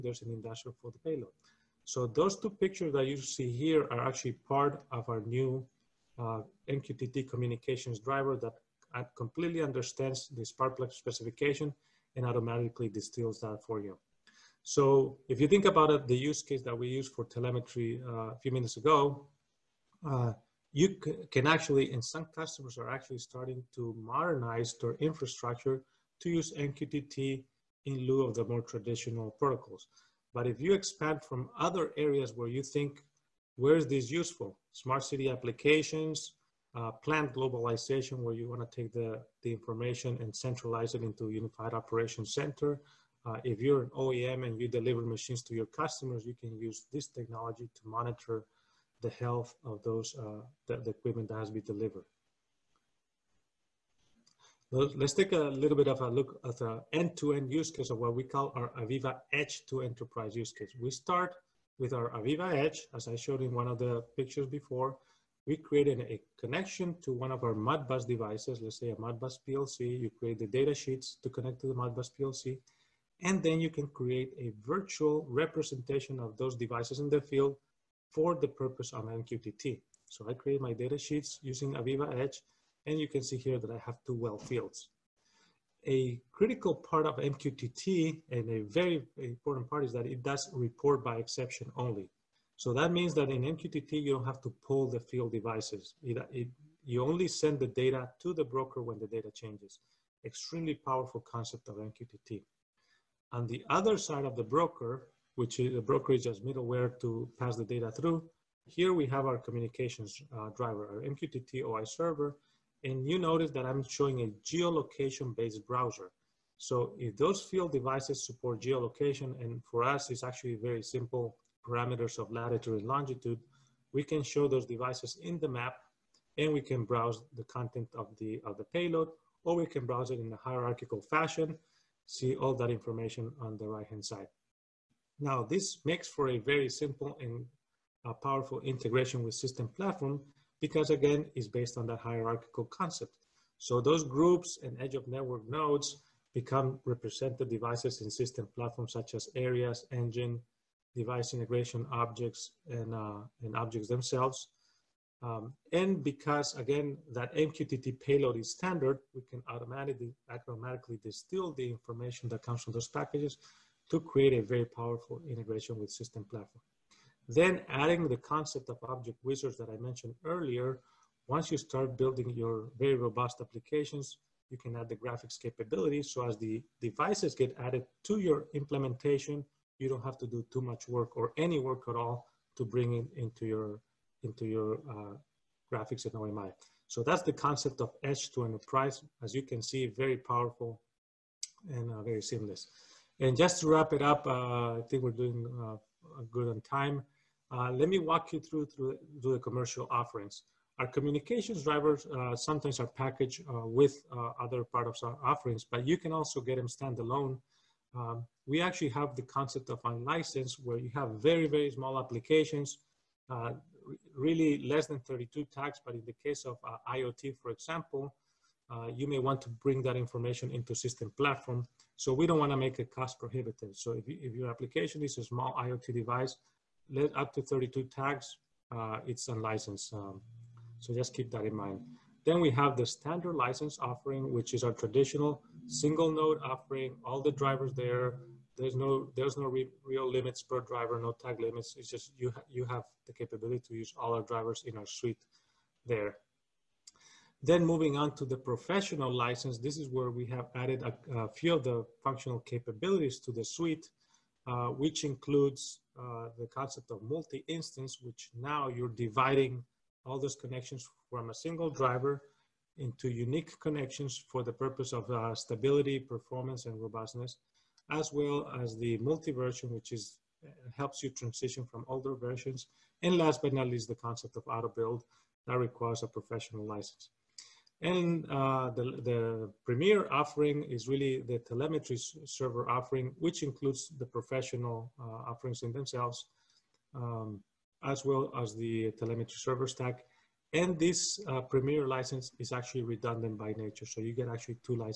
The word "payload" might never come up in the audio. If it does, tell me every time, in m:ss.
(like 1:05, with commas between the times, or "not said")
0:00, 2:08, 2:37.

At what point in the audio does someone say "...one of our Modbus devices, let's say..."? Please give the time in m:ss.
1:07.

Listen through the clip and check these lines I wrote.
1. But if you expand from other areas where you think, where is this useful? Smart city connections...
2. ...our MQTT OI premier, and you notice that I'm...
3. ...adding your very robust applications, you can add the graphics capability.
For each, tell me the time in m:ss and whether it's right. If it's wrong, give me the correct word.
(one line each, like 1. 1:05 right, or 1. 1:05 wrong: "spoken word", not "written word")
1. 0:30 wrong: "applications", not "connections"
2. 1:50 wrong: "server", not "premier"
3. 2:51 wrong: "building", not "adding".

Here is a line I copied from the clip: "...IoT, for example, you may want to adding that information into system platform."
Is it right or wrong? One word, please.
wrong.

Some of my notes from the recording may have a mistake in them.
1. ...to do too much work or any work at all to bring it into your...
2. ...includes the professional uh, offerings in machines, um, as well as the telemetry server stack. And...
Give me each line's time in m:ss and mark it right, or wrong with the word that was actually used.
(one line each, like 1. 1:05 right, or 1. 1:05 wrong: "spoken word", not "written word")
1. 3:00 right
2. 4:43 wrong: "themselves", not "machines".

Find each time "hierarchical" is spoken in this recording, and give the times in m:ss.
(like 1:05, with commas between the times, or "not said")
2:10, 2:21.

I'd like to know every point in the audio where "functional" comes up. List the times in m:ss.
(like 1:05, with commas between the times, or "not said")
4:12.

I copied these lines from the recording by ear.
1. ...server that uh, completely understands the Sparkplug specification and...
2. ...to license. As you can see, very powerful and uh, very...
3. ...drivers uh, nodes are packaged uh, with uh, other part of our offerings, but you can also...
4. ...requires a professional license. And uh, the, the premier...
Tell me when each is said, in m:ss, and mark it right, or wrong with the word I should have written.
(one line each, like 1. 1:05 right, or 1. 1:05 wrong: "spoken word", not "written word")
1. 0:07 wrong: "driver", not "server"
2. 3:08 wrong: "enterprise", not "license"
3. 3:21 wrong: "sometimes", not "nodes"
4. 4:35 right.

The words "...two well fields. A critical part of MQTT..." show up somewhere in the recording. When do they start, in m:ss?
1:24.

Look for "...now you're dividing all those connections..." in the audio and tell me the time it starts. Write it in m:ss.
4:18.